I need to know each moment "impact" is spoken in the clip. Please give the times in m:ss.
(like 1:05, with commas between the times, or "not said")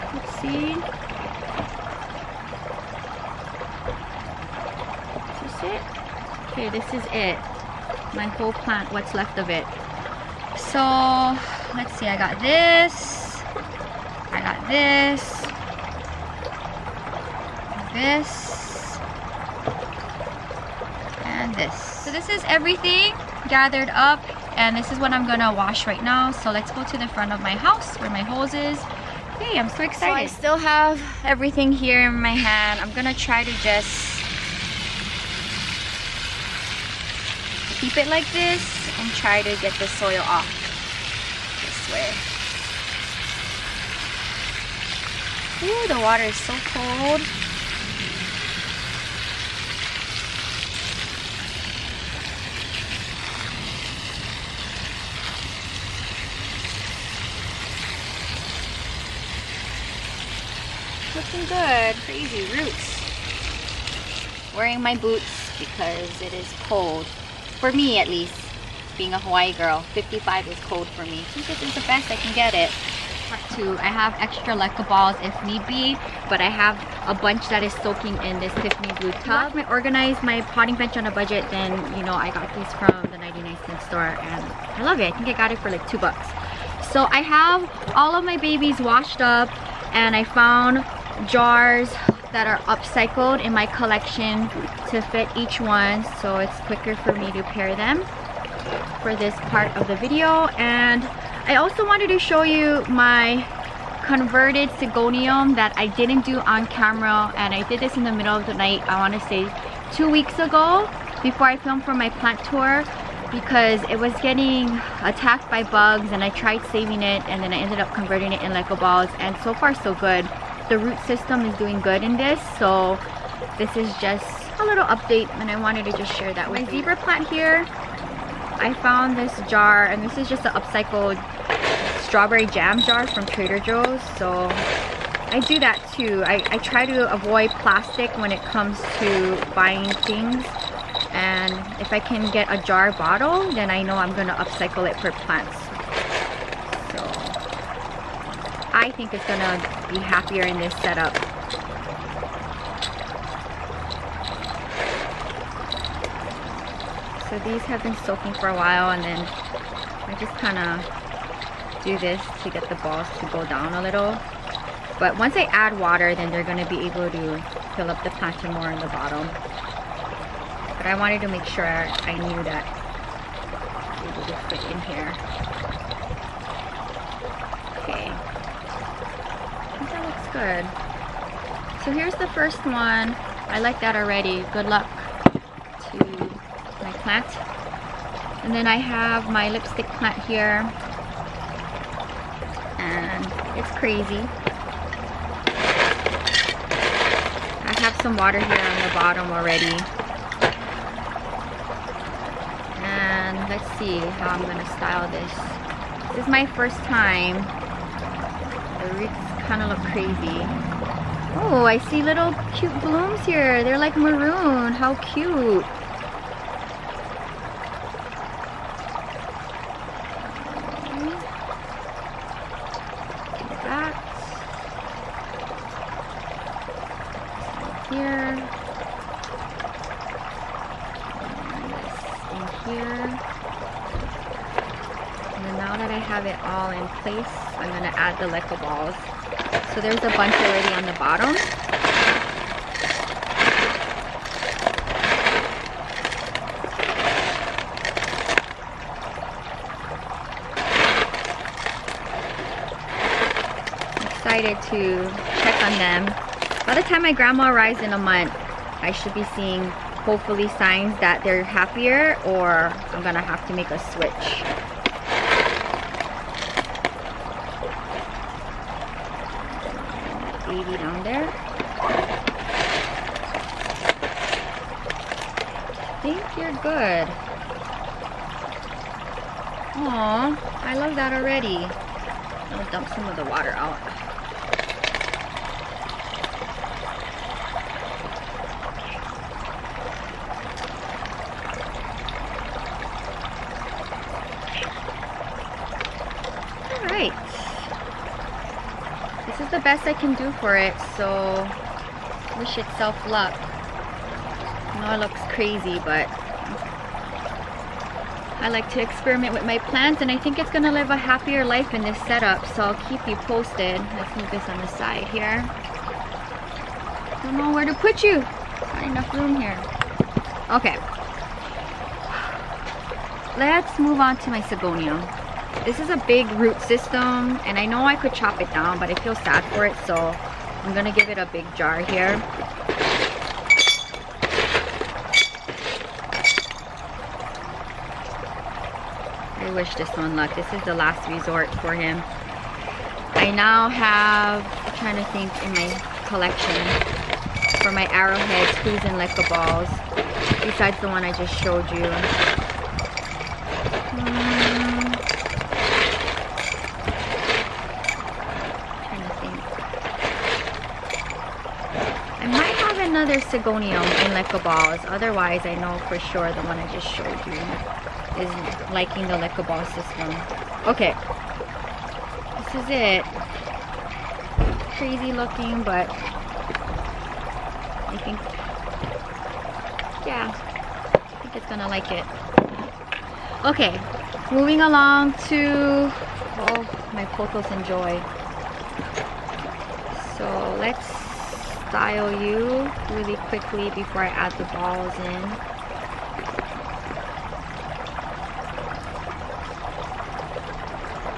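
not said.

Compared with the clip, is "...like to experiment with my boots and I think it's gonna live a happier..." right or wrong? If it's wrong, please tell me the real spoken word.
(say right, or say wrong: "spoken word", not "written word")
wrong: "plants", not "boots".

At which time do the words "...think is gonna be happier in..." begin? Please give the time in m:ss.
2:28.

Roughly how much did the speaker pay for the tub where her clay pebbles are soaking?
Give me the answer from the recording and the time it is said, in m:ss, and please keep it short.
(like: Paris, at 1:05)
two bucks, at 1:25.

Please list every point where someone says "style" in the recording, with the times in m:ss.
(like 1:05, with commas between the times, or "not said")
3:24, 6:31.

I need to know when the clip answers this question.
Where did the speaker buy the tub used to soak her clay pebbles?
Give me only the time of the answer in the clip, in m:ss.
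1:23.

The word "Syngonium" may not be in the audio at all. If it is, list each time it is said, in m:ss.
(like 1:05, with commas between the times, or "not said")
1:44, 5:24, 6:03.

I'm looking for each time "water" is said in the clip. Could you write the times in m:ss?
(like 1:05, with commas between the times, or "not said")
0:46, 2:45, 3:18, 4:43.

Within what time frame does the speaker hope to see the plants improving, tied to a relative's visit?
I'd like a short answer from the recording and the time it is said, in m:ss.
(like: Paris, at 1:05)
a month, at 4:17.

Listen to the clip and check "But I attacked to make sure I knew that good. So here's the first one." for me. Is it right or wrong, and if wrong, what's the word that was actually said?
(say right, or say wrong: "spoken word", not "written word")
wrong: "wanted", not "attacked".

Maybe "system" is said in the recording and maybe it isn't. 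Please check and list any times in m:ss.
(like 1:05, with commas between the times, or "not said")
2:01, 5:26, 6:09.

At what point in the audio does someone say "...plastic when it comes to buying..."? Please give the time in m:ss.
2:17.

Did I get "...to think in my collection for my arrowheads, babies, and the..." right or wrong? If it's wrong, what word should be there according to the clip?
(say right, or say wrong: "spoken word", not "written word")
wrong: "clues", not "babies".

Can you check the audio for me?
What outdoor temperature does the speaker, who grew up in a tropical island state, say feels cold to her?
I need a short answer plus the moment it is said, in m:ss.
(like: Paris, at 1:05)
55, at 1:09.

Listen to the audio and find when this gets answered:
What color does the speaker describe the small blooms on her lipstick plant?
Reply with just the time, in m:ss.
3:33.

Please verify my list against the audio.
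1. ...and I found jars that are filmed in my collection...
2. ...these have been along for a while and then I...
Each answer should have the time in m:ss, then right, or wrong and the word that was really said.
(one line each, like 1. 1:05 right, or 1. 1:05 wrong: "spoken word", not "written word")
1. 1:29 wrong: "upcycled", not "filmed"
2. 2:37 wrong: "soaking", not "along".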